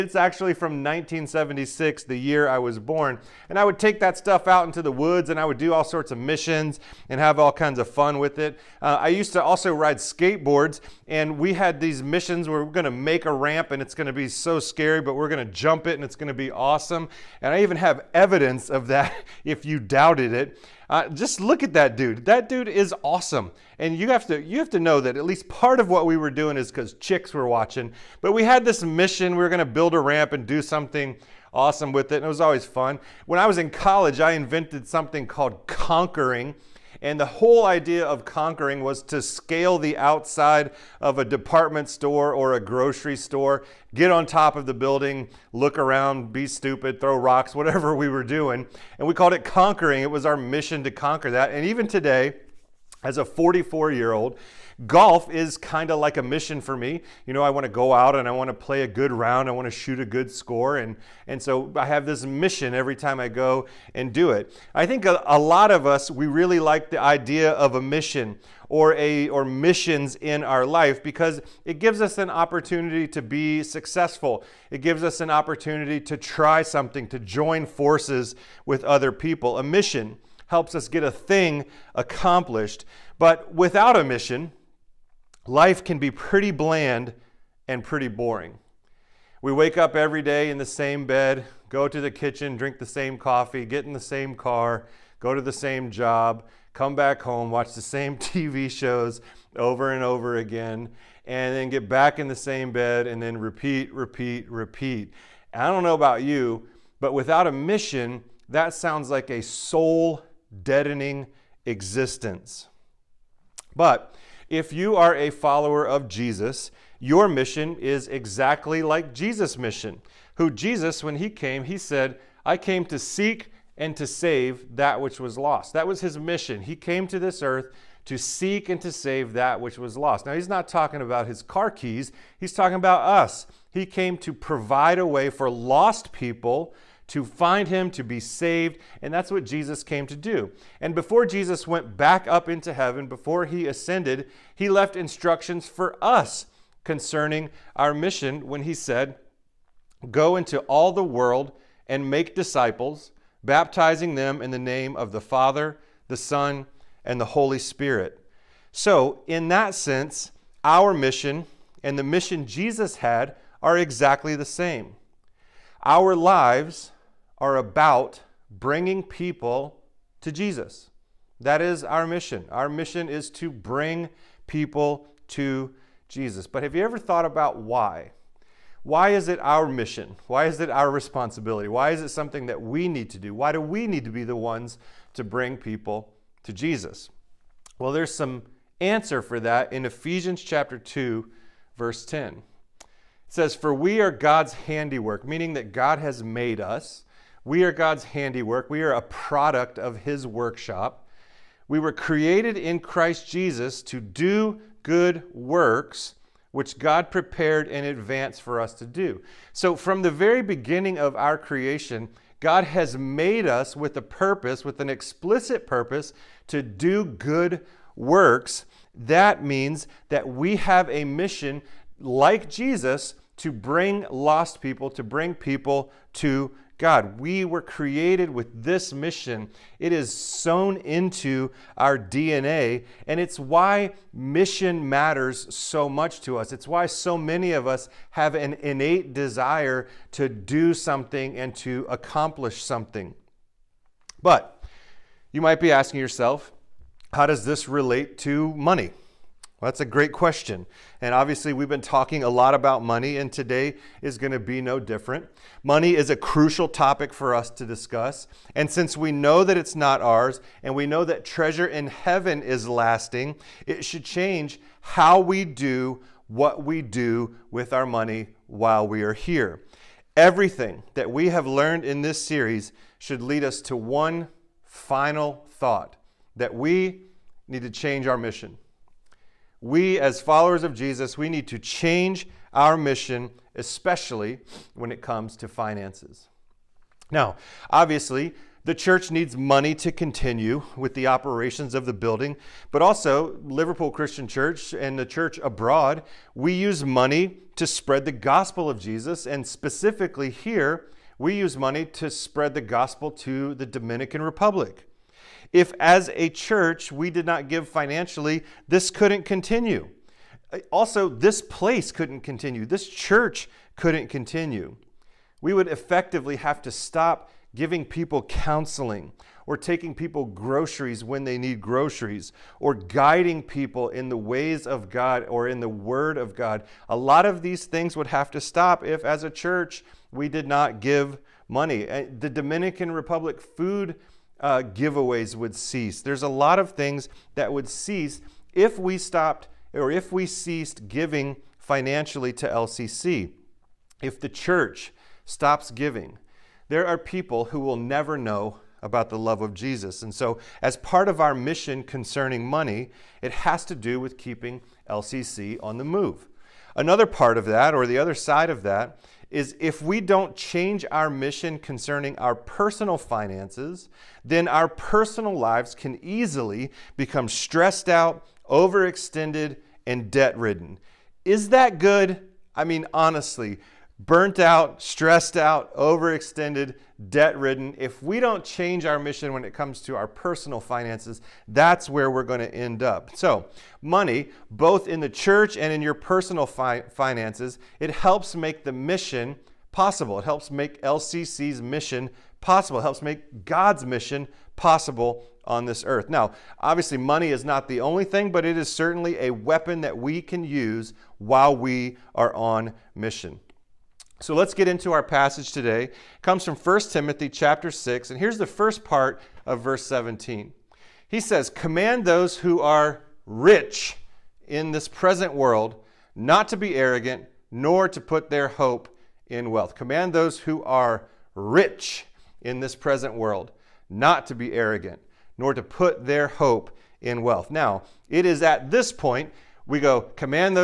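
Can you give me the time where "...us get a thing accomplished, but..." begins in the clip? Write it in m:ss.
1:20.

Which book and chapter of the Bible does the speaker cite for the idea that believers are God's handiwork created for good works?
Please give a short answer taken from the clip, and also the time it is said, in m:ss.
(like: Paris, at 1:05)
Ephesians chapter 2, at 3:09.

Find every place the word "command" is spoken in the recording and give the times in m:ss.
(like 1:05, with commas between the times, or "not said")
6:51, 6:59, 7:10.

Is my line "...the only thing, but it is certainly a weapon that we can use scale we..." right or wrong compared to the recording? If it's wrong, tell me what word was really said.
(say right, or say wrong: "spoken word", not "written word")
wrong: "while", not "scale".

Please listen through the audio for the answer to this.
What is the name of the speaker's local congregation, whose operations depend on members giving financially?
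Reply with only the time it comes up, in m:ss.
4:53.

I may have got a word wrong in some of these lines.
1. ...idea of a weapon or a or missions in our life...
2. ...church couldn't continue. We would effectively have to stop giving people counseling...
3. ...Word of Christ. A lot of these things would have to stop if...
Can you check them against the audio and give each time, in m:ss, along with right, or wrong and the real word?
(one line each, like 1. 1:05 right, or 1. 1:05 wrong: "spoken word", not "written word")
1. 1:06 wrong: "mission", not "weapon"
2. 5:12 right
3. 5:25 wrong: "God", not "Christ".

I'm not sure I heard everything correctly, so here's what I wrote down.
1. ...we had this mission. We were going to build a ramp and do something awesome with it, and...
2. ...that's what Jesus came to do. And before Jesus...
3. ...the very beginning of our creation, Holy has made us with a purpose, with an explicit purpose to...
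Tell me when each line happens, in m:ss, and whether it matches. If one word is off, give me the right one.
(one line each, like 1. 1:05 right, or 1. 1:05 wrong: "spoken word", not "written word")
1. 0:28 right
2. 2:19 right
3. 3:30 wrong: "God", not "Holy".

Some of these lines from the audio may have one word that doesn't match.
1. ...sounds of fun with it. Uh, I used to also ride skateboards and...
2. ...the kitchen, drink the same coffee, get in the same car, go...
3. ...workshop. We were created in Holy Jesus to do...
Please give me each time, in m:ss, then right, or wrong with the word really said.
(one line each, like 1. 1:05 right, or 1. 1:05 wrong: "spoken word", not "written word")
1. 0:07 wrong: "kinds", not "sounds"
2. 1:31 right
3. 3:20 wrong: "Christ", not "Holy".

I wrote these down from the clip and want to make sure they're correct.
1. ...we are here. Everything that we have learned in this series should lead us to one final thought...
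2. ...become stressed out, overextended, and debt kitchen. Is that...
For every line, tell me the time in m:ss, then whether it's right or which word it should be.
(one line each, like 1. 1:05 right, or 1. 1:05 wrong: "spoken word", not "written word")
1. 4:28 right
2. 6:06 wrong: "ridden", not "kitchen".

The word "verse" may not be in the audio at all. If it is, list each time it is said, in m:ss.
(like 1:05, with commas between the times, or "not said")
3:11, 6:49.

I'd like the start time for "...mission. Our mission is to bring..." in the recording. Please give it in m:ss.
2:52.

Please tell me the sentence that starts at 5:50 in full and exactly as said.
And so, as part of our mission concerning money, it has to do with keeping LCC on the move.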